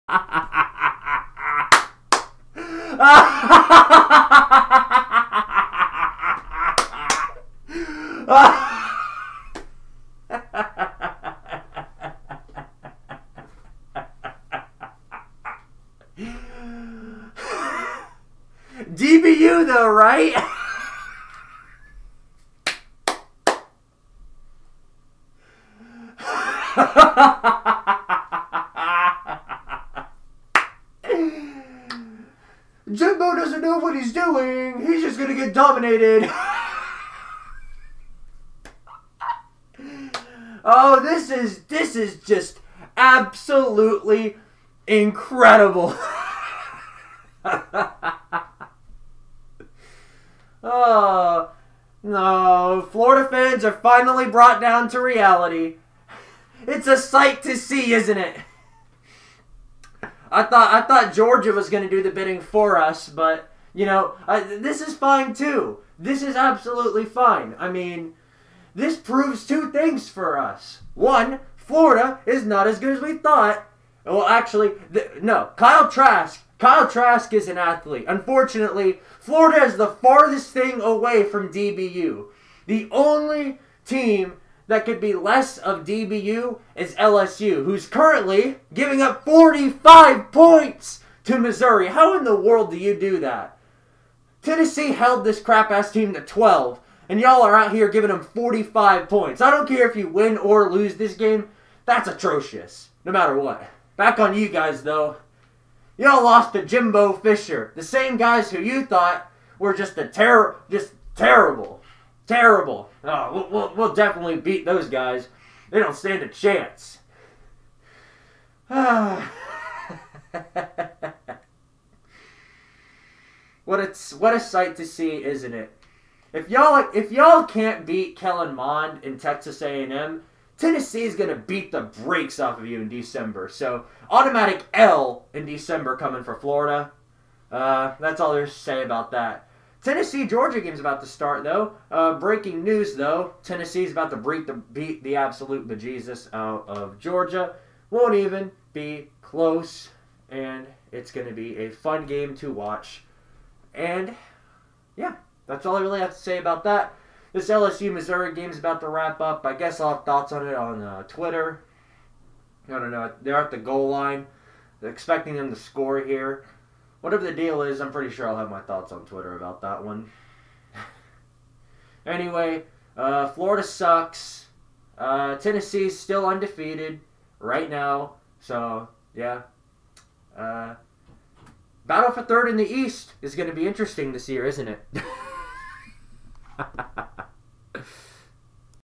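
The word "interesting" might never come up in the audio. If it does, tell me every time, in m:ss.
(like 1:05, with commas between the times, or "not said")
3:03.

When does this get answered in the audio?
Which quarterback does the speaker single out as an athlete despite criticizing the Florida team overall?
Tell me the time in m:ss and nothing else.
1:16.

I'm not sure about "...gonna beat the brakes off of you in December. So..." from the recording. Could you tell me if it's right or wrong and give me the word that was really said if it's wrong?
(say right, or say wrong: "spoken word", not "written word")
right.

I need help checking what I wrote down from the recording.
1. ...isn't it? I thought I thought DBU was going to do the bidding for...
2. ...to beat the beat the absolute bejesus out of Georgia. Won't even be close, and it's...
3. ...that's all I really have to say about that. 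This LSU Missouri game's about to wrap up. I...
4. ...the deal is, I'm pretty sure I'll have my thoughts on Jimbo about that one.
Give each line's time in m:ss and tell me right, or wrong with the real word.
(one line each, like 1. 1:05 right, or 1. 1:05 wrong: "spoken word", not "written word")
1. 0:57 wrong: "Georgia", not "DBU"
2. 2:24 right
3. 2:35 right
4. 2:47 wrong: "Twitter", not "Jimbo".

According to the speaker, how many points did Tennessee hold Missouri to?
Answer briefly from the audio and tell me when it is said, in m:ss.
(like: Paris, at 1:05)
12, at 1:36.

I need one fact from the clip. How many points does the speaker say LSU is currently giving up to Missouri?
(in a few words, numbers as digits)
45.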